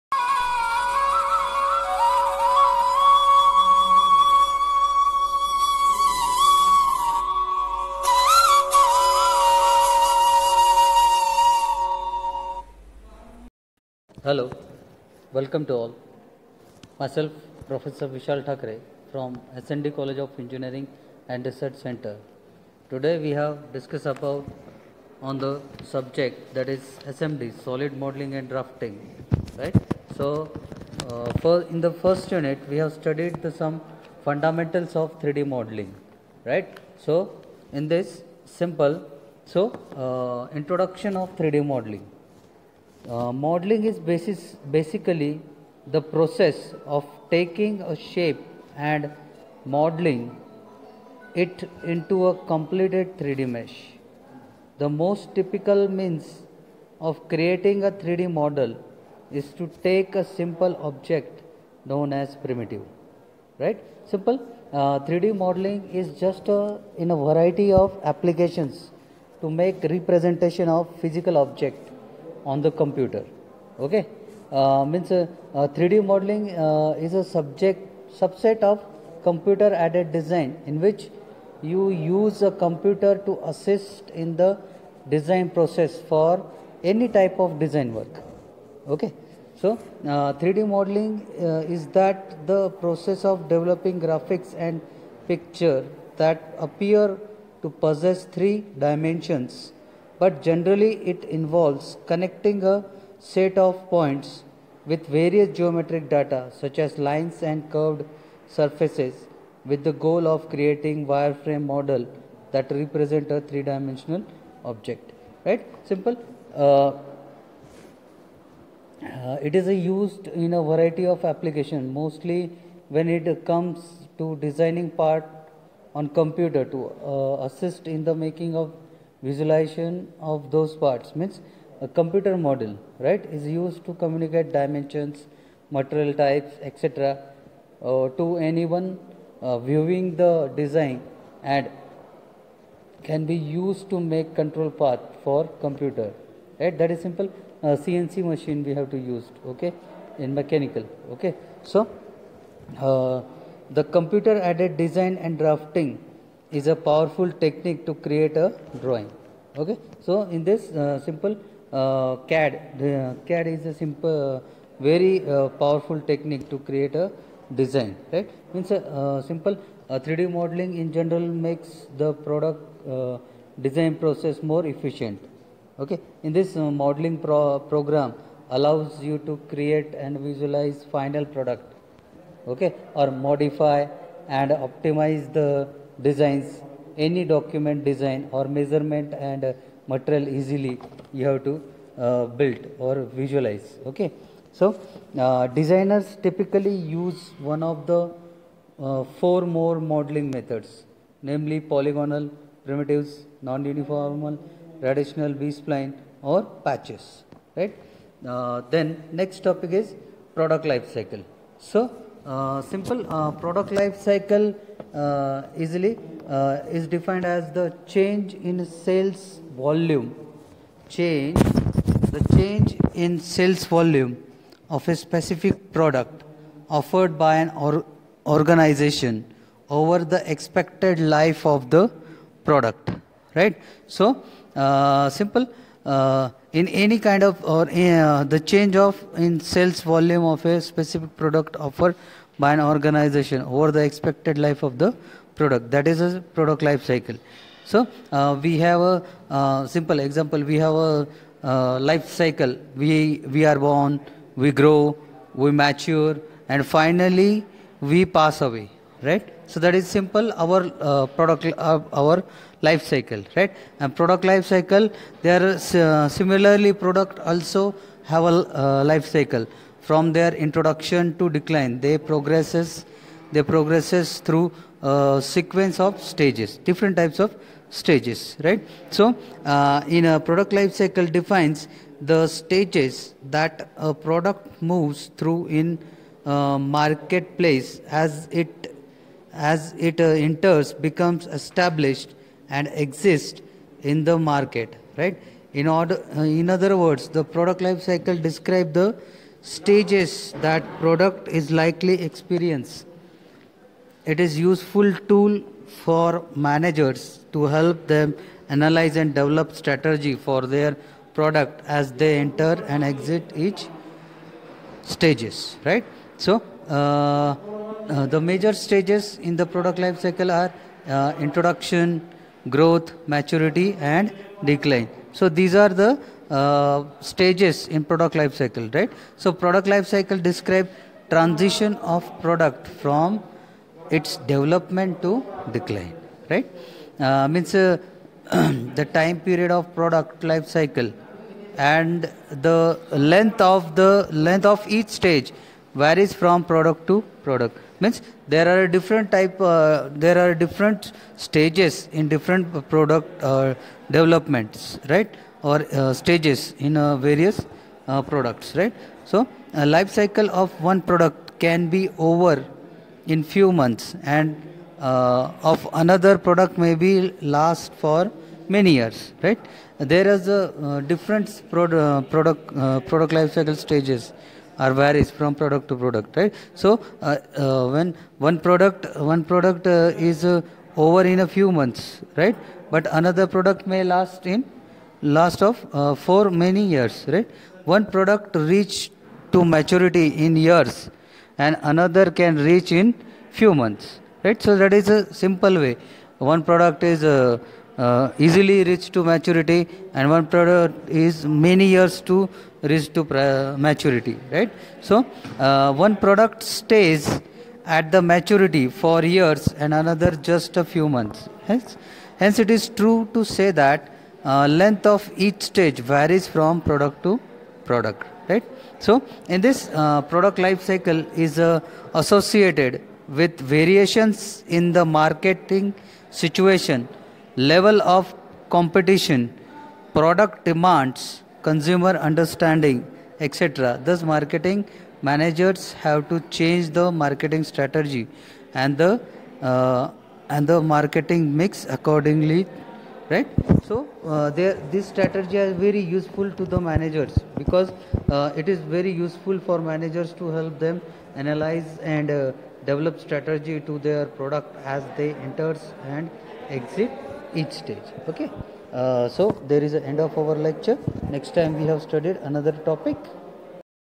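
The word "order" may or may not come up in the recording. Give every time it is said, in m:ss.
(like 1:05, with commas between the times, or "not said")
4:55.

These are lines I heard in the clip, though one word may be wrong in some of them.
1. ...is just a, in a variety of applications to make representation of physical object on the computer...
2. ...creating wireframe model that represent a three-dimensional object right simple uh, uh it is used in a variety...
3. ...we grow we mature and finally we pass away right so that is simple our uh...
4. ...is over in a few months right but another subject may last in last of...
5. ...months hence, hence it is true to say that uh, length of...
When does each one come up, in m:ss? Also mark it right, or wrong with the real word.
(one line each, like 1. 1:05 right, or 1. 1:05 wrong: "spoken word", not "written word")
1. 1:05 right
2. 1:50 right
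3. 4:14 right
4. 6:20 wrong: "product", not "subject"
5. 6:50 right.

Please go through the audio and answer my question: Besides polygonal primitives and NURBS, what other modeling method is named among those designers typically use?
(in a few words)
patches.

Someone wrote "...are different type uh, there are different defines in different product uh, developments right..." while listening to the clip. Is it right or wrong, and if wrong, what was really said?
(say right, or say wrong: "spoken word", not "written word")
wrong: "stages", not "defines".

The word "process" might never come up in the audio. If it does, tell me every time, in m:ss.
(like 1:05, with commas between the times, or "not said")
0:46, 1:25, 1:32, 2:54.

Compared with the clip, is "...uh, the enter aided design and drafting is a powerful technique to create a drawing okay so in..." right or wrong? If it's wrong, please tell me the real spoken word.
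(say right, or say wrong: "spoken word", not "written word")
wrong: "computer", not "enter".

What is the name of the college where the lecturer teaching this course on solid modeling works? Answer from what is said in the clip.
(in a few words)
SND College of Engineering and Research Center.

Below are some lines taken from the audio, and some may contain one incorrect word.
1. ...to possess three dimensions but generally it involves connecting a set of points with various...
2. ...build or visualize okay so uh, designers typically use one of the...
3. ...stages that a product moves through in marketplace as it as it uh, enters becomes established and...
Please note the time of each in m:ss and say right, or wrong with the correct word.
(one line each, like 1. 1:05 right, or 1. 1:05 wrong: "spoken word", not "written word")
1. 1:37 right
2. 3:12 right
3. 4:42 right.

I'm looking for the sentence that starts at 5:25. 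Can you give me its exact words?
So these are the uh, stages in product life cycle, right?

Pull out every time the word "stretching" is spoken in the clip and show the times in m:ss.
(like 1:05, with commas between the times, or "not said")
not said.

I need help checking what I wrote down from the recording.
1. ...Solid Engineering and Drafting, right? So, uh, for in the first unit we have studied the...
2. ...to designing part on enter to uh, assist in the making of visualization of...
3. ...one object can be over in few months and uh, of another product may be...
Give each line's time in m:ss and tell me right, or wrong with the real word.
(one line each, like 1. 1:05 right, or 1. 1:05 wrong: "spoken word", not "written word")
1. 0:27 wrong: "Modeling", not "Engineering"
2. 2:04 wrong: "computer", not "enter"
3. 6:00 wrong: "product", not "object".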